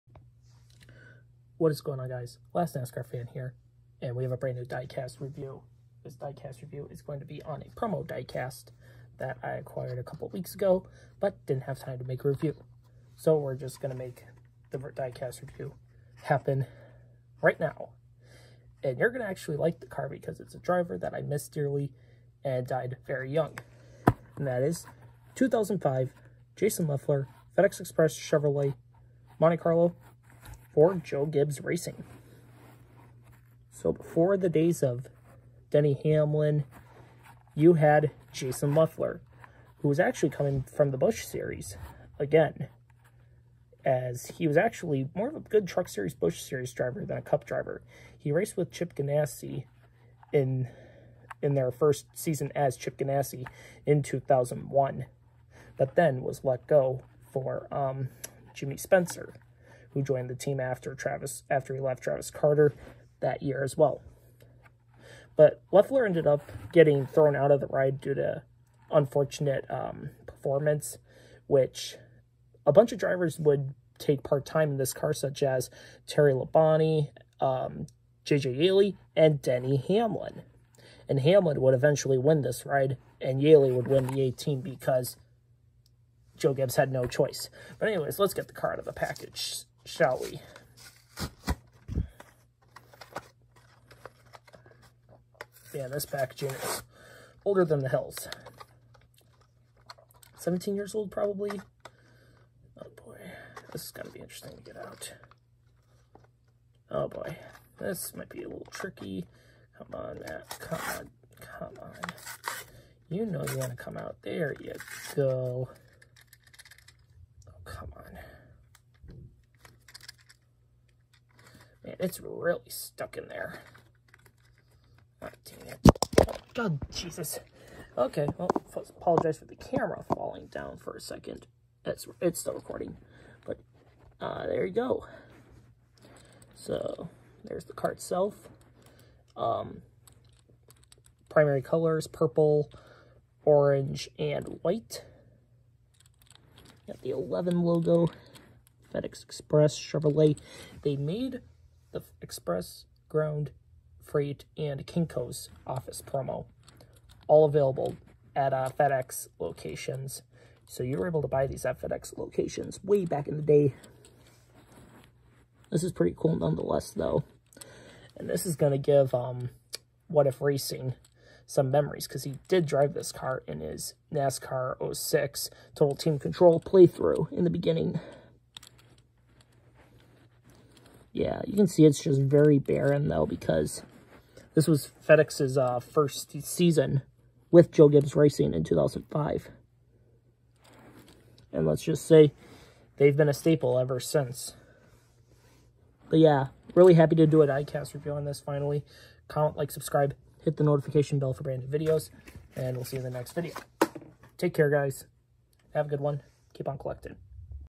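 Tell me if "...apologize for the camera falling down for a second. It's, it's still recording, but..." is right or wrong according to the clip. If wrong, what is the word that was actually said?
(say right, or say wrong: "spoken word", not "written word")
right.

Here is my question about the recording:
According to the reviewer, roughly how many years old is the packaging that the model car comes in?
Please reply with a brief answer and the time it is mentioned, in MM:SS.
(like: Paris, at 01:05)
17, at 01:40.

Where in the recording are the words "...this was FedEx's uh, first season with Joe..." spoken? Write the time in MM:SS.
03:04.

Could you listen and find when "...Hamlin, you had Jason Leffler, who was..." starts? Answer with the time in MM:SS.
00:36.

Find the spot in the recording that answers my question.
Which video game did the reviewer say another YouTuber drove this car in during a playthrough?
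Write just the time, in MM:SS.
02:54.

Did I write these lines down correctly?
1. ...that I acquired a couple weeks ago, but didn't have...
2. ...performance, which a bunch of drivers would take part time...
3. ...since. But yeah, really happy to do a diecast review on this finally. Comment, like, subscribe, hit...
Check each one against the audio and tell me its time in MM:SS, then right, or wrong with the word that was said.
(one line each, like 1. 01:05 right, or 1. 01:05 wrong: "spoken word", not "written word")
1. 00:09 right
2. 01:10 right
3. 03:13 right.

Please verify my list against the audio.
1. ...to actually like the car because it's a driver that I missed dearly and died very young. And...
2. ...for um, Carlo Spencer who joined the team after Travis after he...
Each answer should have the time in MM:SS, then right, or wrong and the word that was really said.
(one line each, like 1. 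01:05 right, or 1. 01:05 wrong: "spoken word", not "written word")
1. 00:19 right
2. 00:57 wrong: "Jimmy", not "Carlo".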